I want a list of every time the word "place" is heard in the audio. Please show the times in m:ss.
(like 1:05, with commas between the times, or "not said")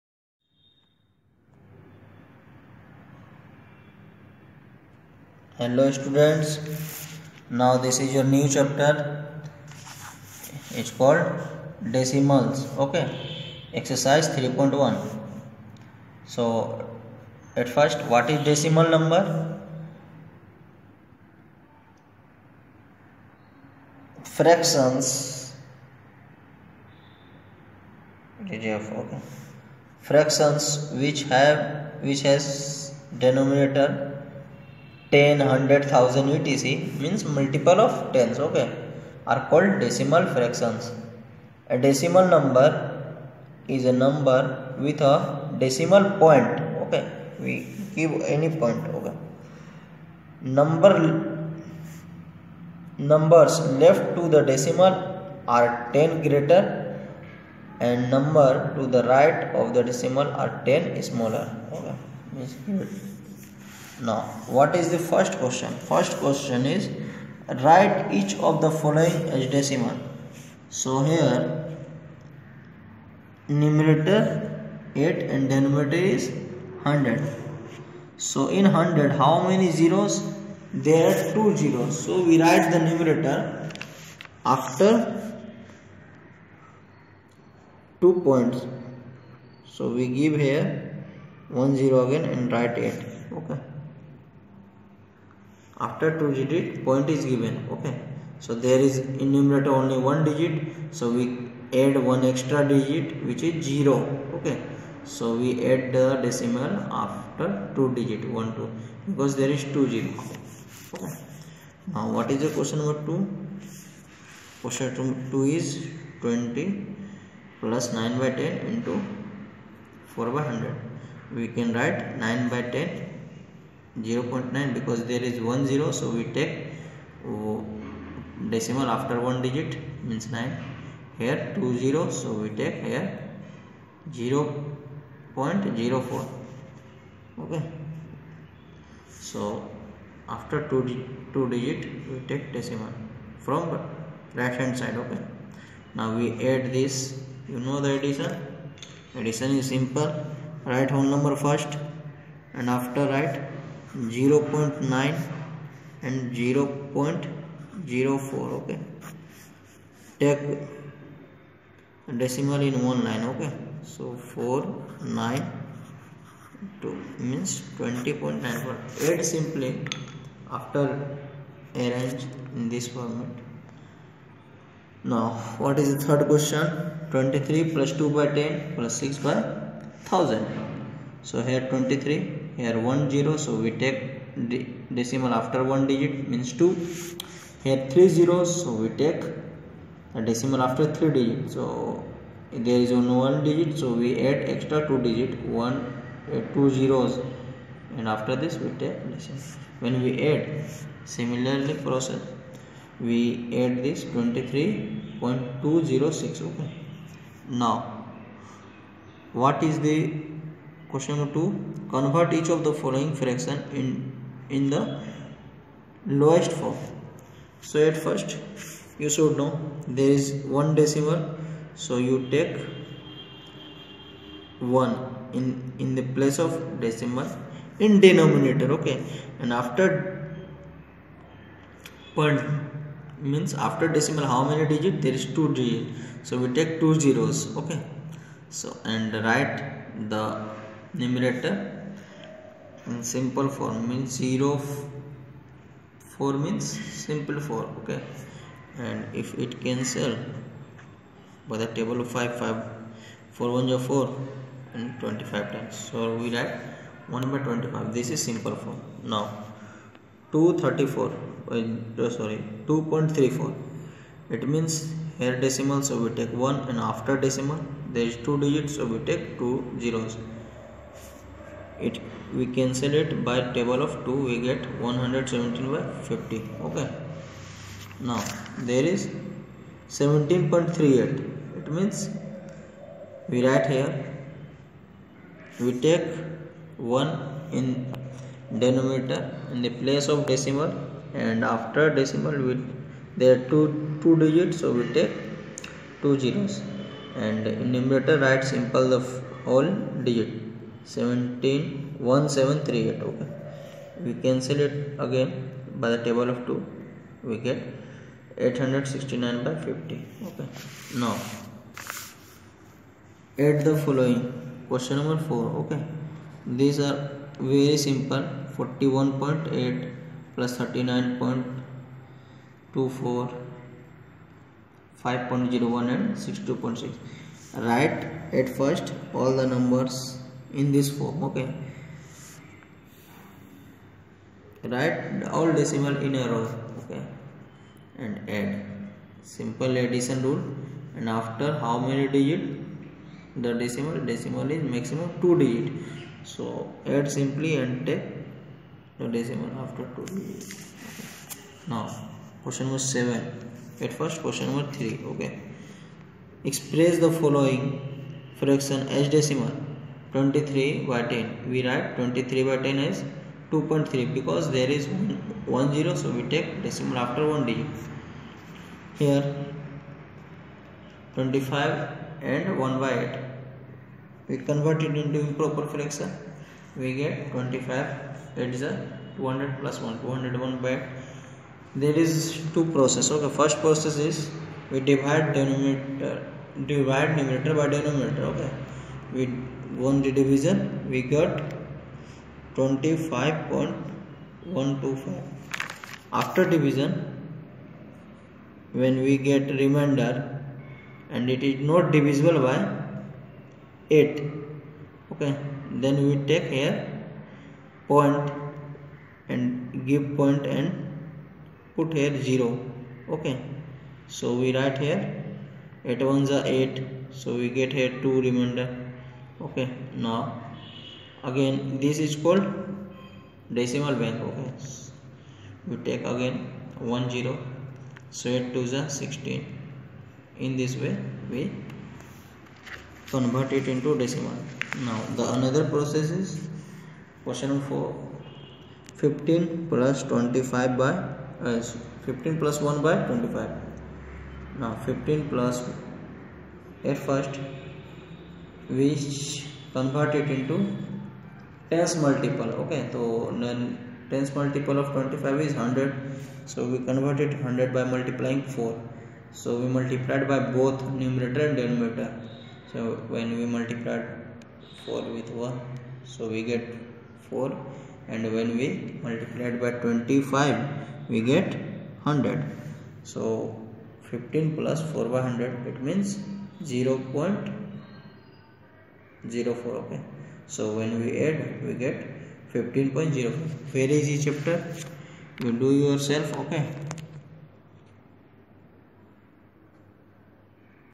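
3:46, 4:49.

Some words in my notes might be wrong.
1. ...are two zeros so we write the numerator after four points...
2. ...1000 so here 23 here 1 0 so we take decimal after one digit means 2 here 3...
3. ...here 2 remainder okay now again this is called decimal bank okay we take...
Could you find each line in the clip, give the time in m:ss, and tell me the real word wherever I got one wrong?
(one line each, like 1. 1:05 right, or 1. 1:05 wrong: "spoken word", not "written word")
1. 1:21 wrong: "two", not "four"
2. 3:00 right
3. 6:57 right.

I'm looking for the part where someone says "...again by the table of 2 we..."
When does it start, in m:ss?
5:05.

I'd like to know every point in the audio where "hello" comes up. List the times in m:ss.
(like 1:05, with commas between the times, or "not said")
0:05.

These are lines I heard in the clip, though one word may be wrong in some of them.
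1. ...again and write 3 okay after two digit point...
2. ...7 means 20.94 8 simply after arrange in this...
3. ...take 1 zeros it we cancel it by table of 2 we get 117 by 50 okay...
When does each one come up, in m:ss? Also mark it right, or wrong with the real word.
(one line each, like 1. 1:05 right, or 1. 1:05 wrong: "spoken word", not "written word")
1. 1:32 wrong: "8", not "3"
2. 2:46 wrong: "2", not "7"
3. 4:29 wrong: "2", not "1".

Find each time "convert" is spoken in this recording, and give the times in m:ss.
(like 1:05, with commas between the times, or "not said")
3:31, 6:14, 7:13, 7:29, 7:36.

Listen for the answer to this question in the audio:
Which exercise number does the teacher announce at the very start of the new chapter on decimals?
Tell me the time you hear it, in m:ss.
0:13.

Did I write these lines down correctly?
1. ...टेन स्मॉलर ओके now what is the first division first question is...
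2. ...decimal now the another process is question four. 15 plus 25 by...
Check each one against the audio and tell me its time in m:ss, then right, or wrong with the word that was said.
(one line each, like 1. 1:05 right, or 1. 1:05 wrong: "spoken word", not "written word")
1. 1:00 wrong: "question", not "division"
2. 7:14 right.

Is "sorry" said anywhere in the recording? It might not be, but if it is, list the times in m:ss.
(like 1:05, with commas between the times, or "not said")
4:22.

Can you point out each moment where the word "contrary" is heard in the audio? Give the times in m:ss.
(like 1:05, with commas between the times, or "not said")
not said.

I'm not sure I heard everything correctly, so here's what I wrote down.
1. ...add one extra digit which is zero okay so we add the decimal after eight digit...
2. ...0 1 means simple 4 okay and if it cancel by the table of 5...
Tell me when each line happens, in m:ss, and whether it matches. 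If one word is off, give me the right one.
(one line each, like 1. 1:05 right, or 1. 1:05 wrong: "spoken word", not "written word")
1. 1:41 wrong: "two", not "eight"
2. 4:04 wrong: "4", not "1".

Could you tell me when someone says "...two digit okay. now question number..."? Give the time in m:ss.
5:49.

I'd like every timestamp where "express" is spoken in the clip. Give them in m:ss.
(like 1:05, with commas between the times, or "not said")
5:56.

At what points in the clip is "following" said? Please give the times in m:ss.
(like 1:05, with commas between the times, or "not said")
1:08, 3:32, 5:13, 5:57.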